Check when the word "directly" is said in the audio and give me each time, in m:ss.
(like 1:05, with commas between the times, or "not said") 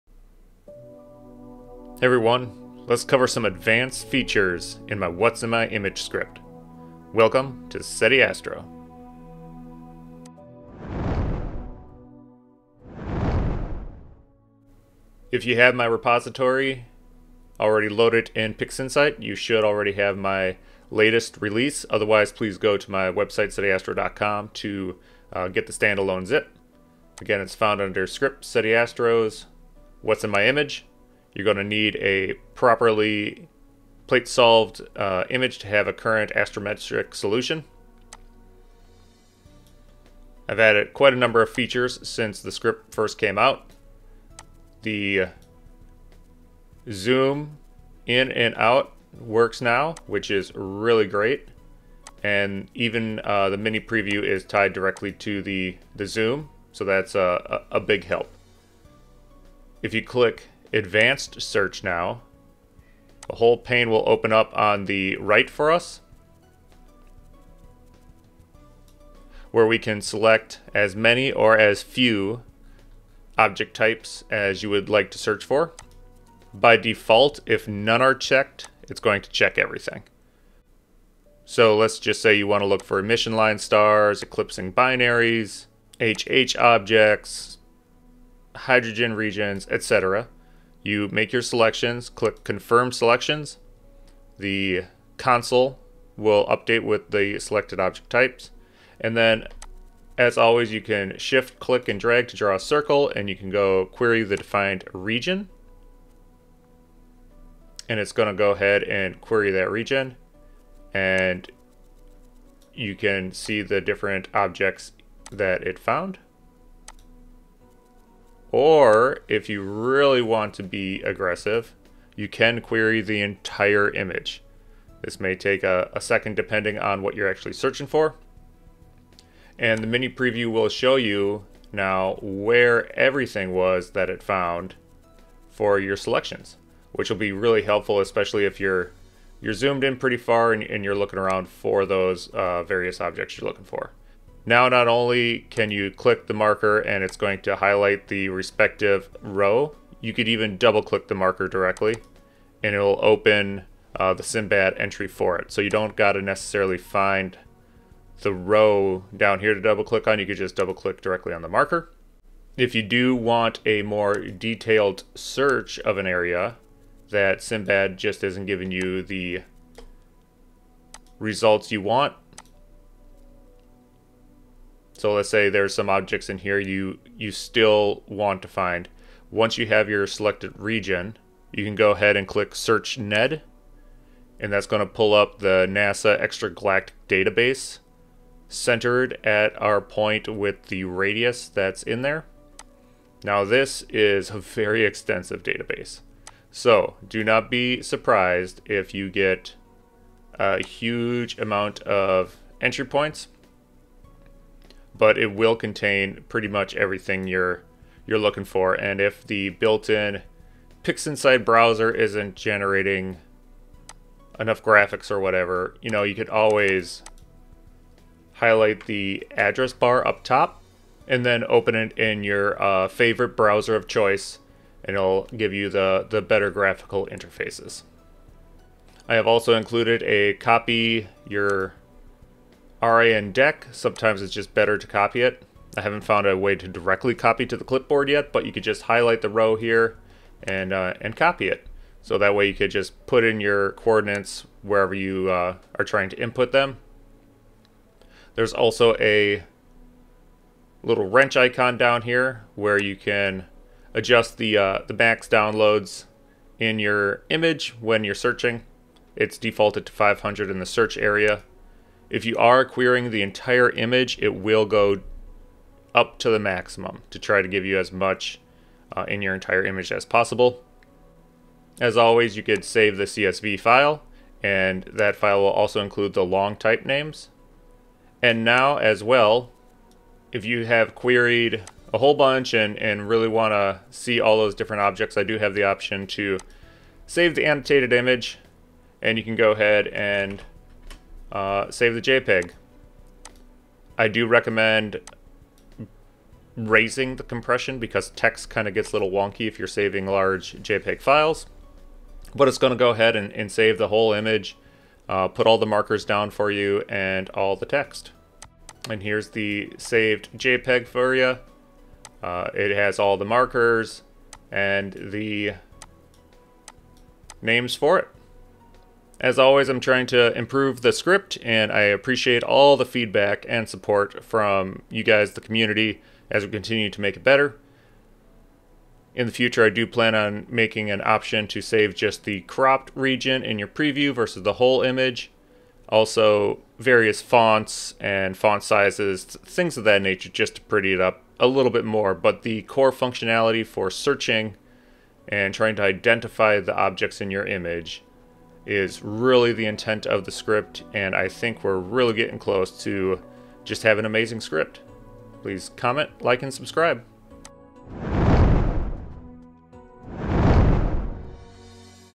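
0:54, 2:31, 2:41, 3:56.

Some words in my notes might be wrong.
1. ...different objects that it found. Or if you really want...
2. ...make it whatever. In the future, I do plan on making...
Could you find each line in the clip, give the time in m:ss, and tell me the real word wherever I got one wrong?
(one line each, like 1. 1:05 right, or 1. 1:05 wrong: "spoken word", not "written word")
1. 1:53 right
2. 5:27 wrong: "better", not "whatever".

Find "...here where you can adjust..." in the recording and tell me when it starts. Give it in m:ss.
4:12.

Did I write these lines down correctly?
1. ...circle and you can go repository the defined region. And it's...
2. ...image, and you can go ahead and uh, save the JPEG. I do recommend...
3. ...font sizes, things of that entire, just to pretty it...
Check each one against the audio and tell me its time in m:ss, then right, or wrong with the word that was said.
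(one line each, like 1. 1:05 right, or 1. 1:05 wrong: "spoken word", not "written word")
1. 1:42 wrong: "query", not "repository"
2. 4:47 right
3. 5:38 wrong: "nature", not "entire".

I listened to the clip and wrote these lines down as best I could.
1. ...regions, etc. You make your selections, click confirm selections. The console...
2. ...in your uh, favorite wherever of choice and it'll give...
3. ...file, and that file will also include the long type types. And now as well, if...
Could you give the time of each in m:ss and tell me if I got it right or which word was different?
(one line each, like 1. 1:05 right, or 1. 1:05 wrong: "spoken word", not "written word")
1. 1:29 right
2. 3:41 wrong: "browser", not "wherever"
3. 4:33 wrong: "names", not "types".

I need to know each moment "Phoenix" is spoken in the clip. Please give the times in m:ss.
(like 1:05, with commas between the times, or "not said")
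not said.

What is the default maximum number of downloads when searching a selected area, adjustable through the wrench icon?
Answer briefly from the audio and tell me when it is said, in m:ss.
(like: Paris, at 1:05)
500, at 4:19.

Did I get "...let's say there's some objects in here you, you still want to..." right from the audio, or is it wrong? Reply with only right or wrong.
right.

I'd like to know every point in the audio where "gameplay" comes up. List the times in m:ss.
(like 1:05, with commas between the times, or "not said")
not said.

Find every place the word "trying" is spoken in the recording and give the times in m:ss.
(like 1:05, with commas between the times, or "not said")
4:05, 5:19, 5:45.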